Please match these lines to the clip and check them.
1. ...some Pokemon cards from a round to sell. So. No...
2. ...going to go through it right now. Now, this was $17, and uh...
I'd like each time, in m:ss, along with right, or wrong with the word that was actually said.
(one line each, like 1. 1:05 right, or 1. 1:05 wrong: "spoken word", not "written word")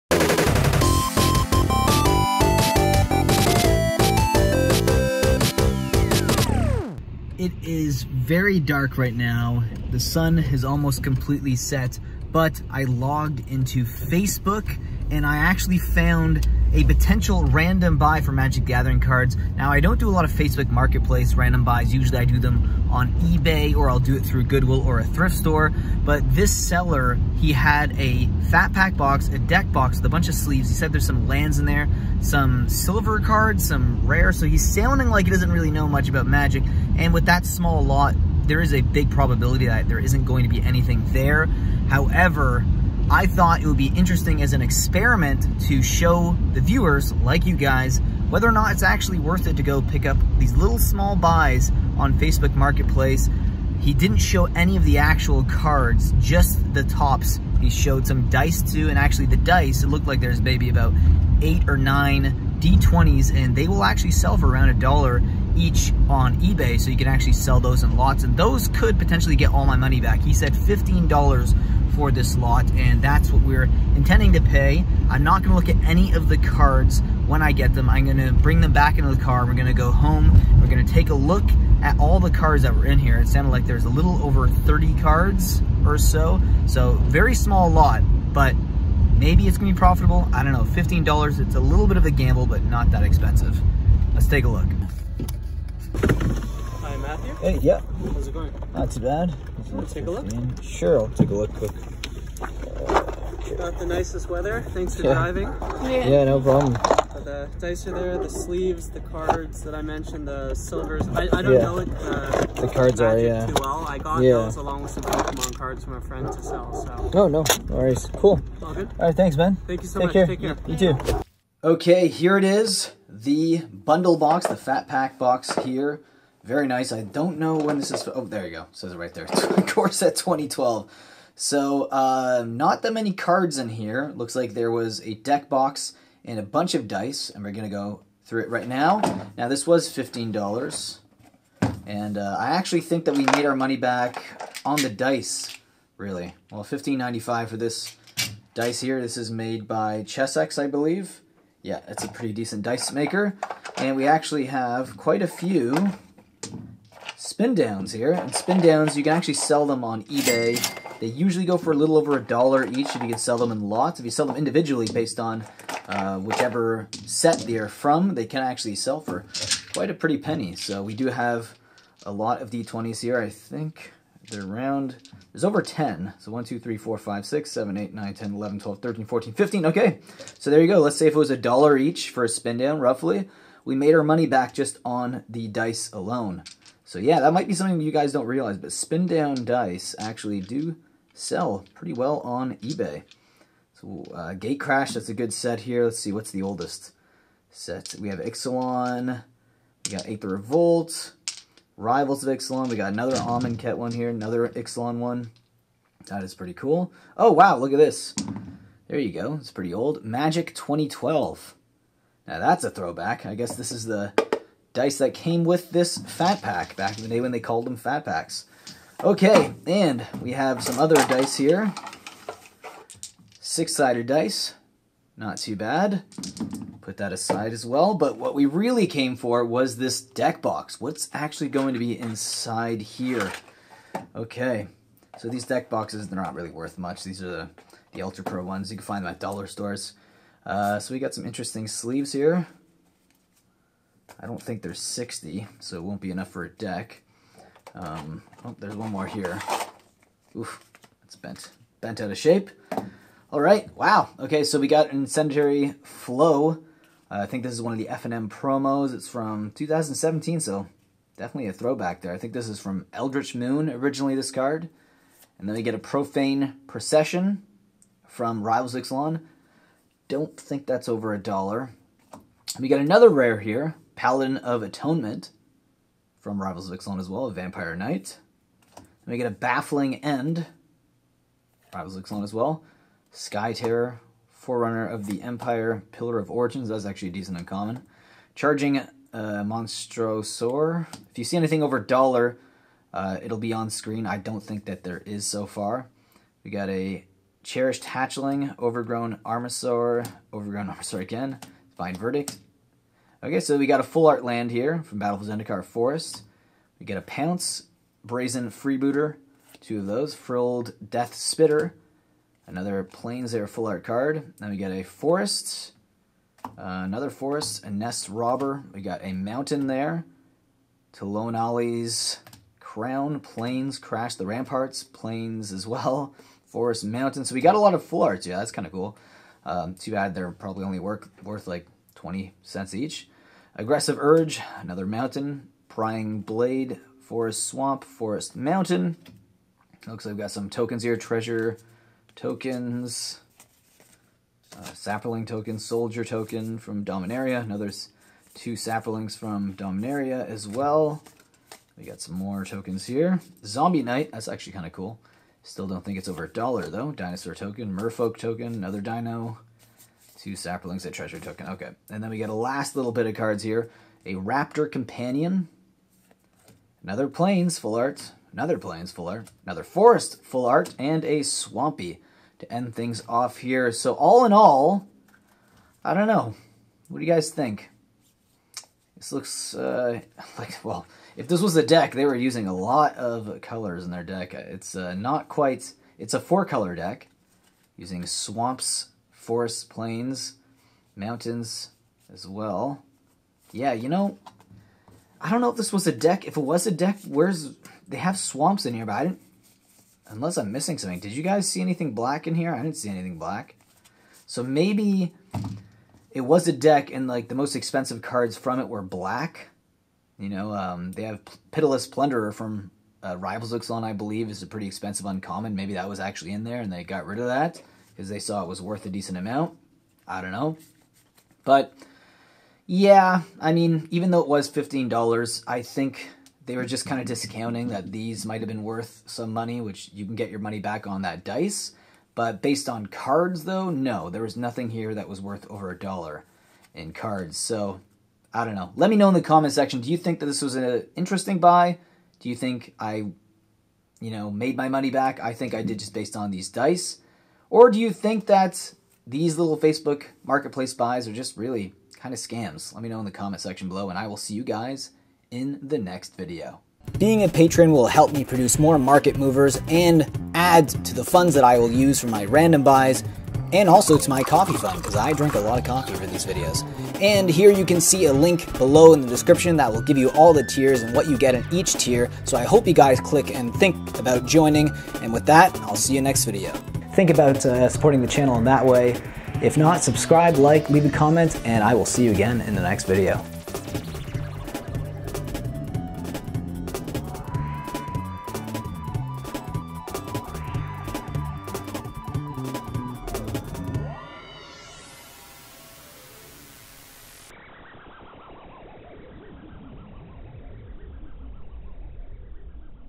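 1. 1:54 wrong: "friend", not "round"
2. 2:17 wrong: "15", not "17".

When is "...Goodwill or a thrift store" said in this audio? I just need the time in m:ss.
0:24.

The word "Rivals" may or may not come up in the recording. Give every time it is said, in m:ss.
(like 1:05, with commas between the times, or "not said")
3:21, 4:28, 4:36, 4:41, 6:53.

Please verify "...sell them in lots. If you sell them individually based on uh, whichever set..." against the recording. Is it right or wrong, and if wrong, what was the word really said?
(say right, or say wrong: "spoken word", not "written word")
right.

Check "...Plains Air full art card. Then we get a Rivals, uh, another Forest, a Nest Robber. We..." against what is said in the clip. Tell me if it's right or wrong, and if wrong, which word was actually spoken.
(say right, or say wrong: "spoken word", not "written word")
wrong: "Forest", not "Rivals".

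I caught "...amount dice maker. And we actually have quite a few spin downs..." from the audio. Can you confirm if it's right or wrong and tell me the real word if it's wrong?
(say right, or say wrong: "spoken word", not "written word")
wrong: "decent", not "amount".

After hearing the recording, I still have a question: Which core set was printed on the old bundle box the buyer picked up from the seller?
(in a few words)
Core Set 2012.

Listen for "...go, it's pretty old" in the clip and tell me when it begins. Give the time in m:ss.
3:29.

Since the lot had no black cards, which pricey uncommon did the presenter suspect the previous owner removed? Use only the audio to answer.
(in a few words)
Pitiless Plunderer.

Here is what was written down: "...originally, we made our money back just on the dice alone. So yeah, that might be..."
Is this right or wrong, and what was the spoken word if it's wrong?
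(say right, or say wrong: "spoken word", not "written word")
wrong: "roughly", not "originally".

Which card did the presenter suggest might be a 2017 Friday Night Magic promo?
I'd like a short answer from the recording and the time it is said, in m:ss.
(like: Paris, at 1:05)
Incendiary Flow, at 4:14.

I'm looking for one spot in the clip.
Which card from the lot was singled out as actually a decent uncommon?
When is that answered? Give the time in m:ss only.
4:45.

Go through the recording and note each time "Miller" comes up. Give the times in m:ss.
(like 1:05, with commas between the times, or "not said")
not said.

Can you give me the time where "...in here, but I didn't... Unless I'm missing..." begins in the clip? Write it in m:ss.
6:38.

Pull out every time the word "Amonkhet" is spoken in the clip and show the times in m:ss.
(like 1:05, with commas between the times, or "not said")
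3:23.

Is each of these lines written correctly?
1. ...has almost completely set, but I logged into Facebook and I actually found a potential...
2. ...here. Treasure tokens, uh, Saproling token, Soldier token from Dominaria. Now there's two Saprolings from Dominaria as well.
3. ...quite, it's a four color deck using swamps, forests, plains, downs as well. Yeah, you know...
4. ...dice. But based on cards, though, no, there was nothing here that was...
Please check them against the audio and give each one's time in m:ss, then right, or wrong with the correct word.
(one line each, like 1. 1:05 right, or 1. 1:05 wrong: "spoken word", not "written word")
1. 0:10 right
2. 5:40 right
3. 6:25 wrong: "mountains", not "downs"
4. 7:11 right.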